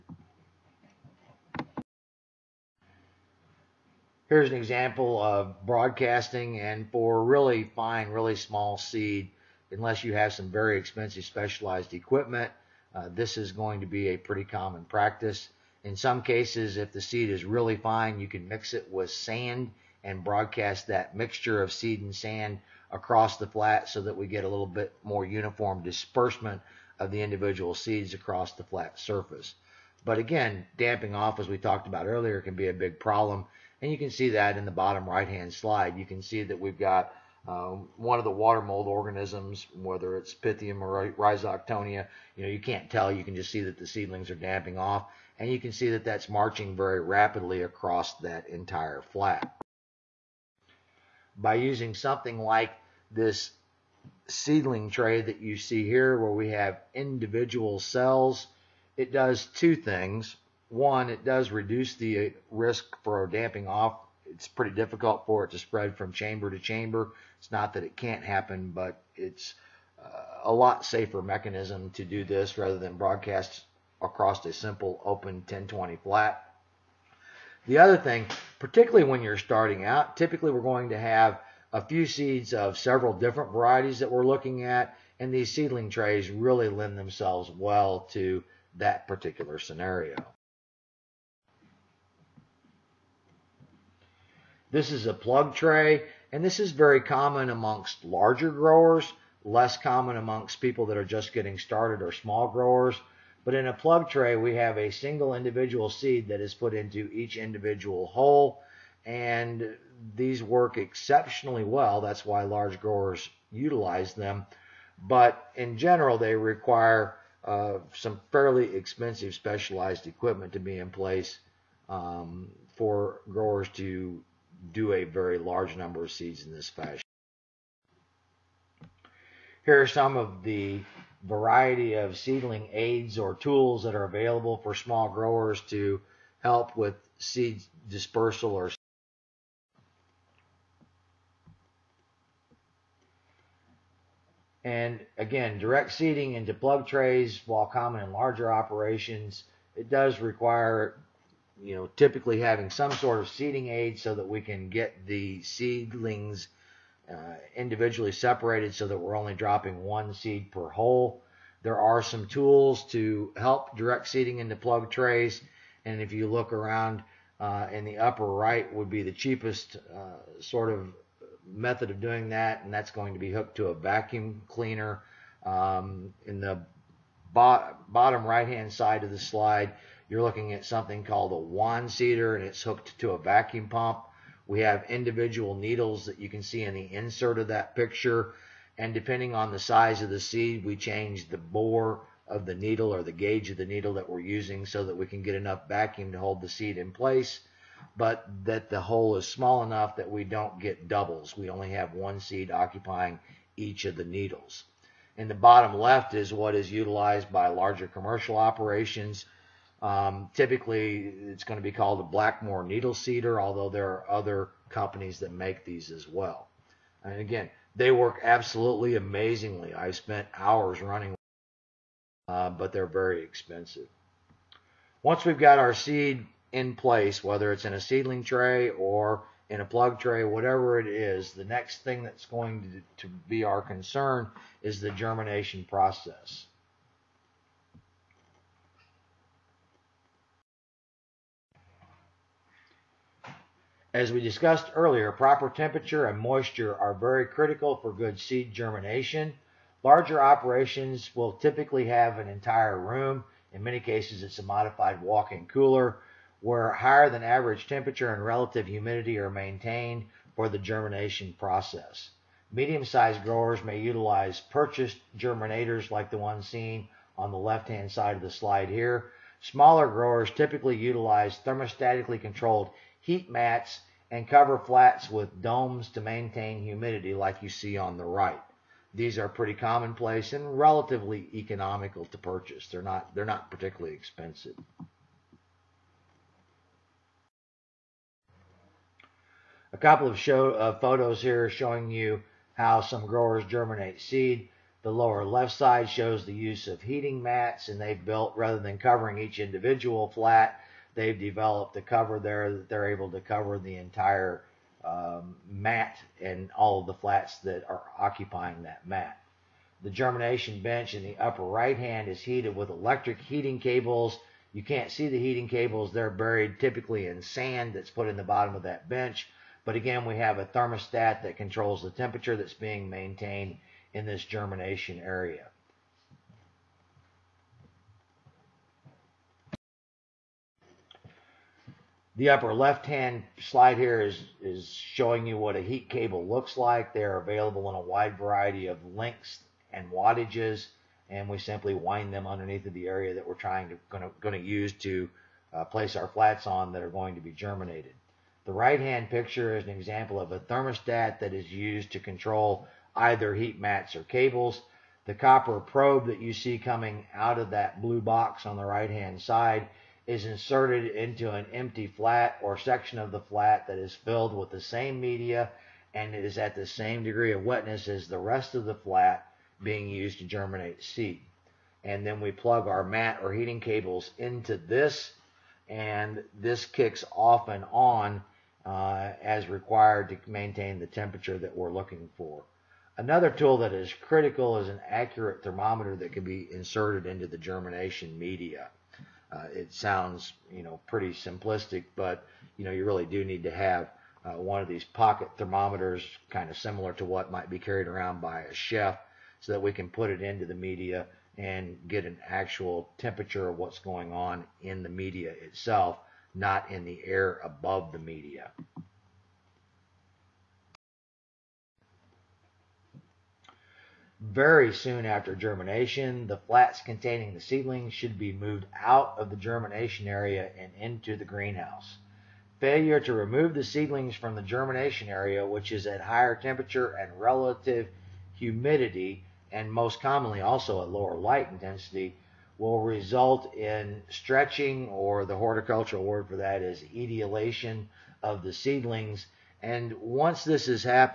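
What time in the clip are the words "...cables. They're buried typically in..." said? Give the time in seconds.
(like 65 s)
315 s.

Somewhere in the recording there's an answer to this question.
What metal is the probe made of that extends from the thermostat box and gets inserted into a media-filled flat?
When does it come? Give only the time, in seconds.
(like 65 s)
355 s.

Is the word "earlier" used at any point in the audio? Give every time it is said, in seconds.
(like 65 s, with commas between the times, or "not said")
32 s, 244 s.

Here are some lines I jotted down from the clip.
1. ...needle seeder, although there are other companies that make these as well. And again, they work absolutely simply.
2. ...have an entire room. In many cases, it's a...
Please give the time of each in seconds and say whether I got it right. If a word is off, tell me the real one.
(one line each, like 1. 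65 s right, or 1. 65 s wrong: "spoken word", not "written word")
1. 212 s wrong: "amazingly", not "simply"
2. 251 s right.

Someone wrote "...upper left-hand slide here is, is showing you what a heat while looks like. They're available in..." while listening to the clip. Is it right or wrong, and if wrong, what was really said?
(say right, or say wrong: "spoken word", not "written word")
wrong: "cable", not "while".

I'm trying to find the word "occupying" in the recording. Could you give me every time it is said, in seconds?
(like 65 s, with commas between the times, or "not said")
202 s, 307 s.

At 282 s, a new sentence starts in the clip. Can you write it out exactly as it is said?
They're not, they're not particularly expensive.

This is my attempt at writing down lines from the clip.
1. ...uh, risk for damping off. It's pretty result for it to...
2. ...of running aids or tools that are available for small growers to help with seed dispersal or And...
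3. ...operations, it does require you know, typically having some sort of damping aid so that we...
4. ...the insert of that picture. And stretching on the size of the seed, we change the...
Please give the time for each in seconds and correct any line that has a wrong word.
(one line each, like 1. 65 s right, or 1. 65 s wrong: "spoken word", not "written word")
1. 62 s wrong: "difficult", not "result"
2. 131 s wrong: "seedling", not "running"
3. 148 s wrong: "seeding", not "damping"
4. 186 s wrong: "depending", not "stretching".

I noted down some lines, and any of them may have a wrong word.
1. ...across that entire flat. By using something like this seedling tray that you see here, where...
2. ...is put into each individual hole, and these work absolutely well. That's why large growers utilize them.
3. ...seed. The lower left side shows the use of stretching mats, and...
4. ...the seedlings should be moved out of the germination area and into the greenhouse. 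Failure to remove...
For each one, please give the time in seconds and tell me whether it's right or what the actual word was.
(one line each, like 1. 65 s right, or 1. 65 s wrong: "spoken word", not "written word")
1. 47 s right
2. 106 s wrong: "exceptionally", not "absolutely"
3. 293 s wrong: "heating", not "stretching"
4. 417 s right.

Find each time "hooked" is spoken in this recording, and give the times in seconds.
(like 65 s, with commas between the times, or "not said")
173 s, 182 s.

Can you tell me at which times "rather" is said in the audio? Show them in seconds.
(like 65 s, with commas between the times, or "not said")
72 s, 298 s.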